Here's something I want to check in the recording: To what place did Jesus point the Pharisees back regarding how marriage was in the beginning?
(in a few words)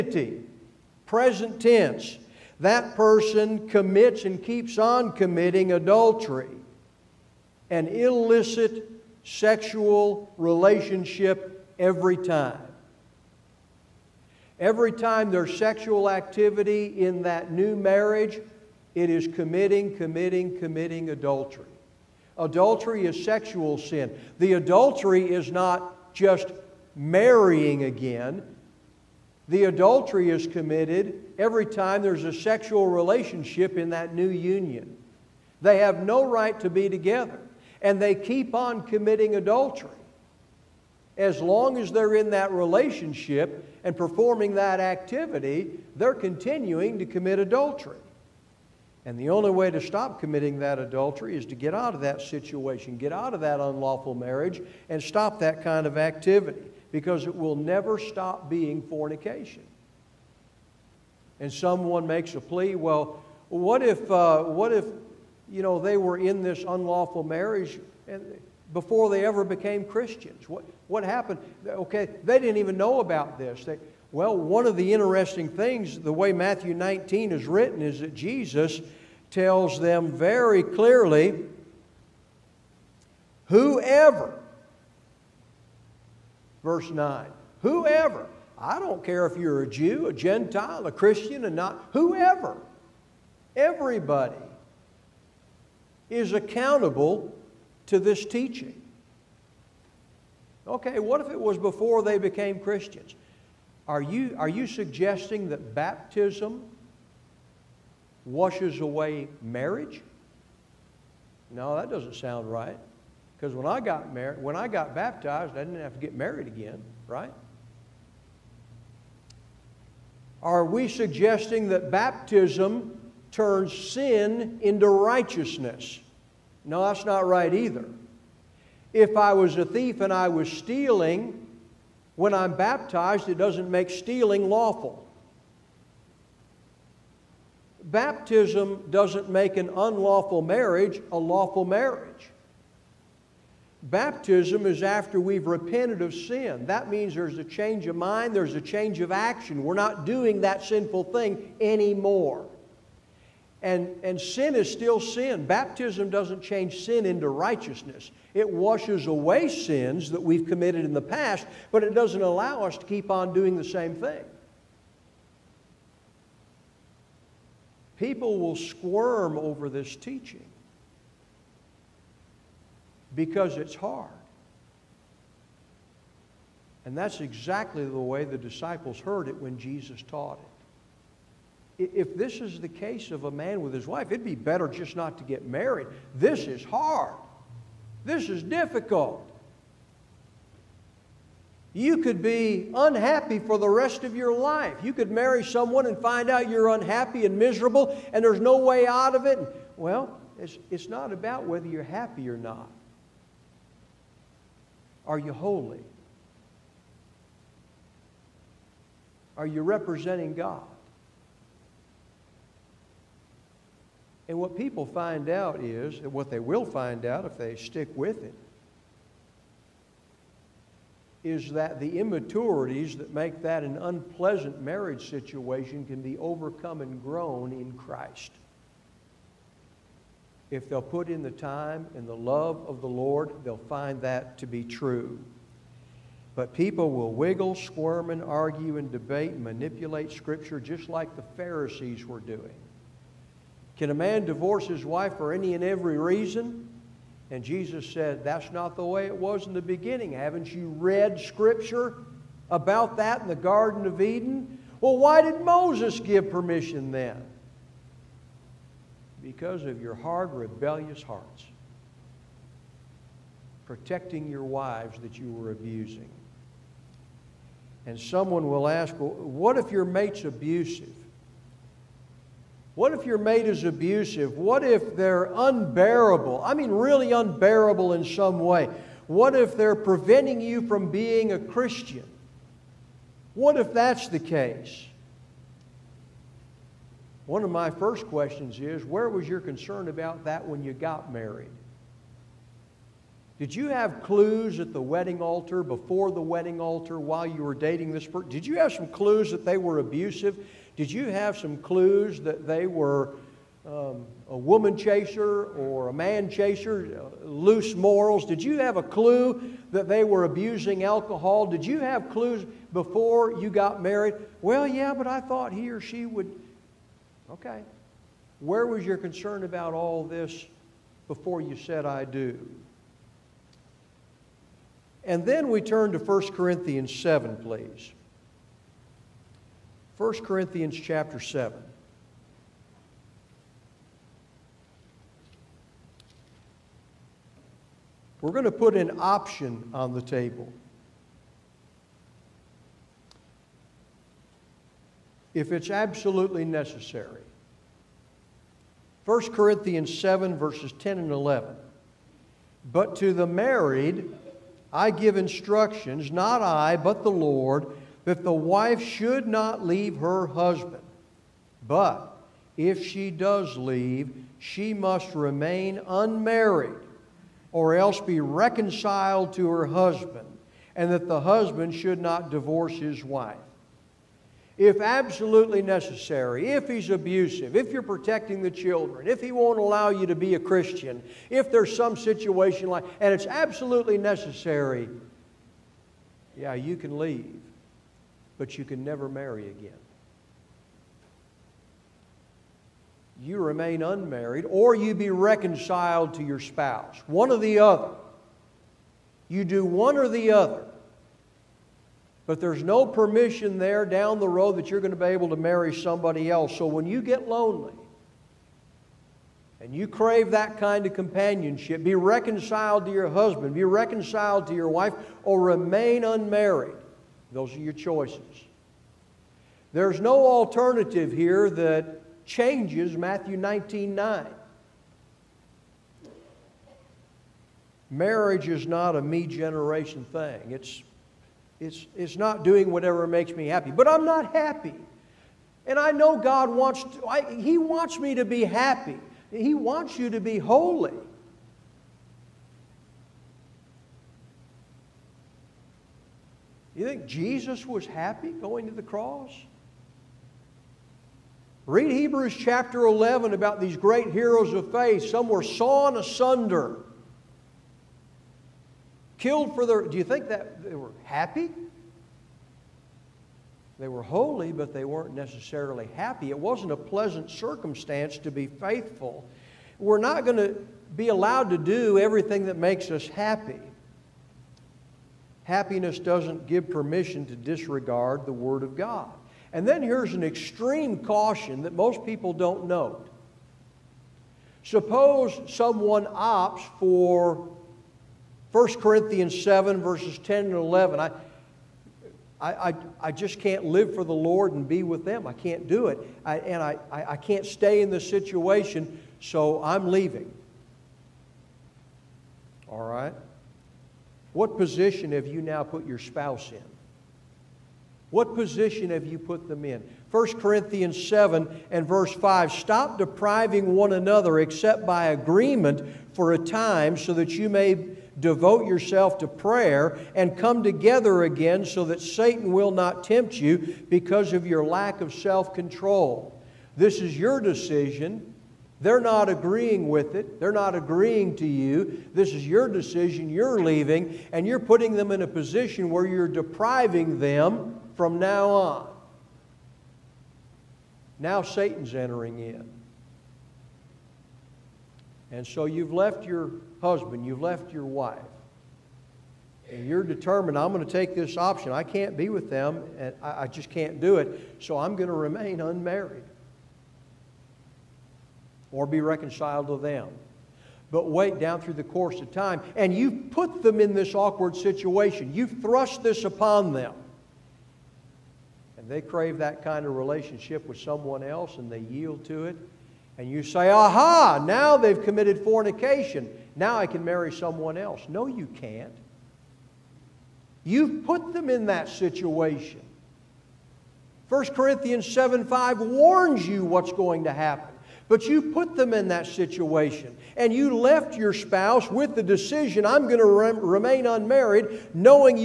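Garden of Eden.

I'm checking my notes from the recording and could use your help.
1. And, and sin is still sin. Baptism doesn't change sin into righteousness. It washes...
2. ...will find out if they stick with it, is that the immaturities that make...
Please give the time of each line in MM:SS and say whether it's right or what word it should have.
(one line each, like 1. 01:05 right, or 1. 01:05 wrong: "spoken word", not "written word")
1. 02:33 right
2. 03:36 right.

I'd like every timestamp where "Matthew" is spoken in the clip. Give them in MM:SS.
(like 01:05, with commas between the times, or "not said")
01:16, 07:02.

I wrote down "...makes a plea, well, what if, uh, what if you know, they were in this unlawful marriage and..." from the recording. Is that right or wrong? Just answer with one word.
right.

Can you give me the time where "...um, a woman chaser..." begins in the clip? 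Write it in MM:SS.
05:03.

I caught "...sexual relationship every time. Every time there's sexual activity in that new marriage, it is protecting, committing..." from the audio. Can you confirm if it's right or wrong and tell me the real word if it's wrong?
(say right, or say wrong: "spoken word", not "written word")
wrong: "committing", not "protecting".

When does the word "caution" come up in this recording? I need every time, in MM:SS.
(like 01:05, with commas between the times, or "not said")
08:00.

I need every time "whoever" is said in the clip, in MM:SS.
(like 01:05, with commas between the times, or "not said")
01:23, 01:27, 01:31.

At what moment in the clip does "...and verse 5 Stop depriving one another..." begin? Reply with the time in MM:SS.
08:31.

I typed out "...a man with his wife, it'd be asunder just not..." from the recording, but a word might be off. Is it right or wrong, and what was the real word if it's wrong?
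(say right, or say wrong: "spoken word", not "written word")
wrong: "better", not "asunder".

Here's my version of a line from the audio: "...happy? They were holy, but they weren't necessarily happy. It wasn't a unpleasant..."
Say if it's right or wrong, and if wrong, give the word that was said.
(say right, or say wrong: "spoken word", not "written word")
wrong: "pleasant", not "unpleasant".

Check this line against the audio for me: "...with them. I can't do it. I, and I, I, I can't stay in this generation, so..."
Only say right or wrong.
wrong.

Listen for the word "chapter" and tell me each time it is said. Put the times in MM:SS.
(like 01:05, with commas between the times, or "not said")
05:30, 07:32.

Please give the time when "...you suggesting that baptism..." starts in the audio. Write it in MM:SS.
01:44.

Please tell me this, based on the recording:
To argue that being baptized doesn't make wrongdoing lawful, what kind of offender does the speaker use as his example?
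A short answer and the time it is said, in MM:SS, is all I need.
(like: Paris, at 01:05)
A thief, at 02:09.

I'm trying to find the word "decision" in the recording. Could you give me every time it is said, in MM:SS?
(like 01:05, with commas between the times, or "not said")
08:47, 08:52, 09:52.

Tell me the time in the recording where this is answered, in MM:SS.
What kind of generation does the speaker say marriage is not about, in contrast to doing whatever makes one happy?
07:09.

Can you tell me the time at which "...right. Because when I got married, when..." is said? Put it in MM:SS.
01:52.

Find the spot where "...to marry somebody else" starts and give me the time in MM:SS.
06:45.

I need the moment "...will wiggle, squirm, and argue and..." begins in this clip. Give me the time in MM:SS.
03:56.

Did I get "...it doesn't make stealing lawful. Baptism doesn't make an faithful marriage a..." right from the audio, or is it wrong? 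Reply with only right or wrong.
wrong.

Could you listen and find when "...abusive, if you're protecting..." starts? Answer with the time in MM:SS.
06:16.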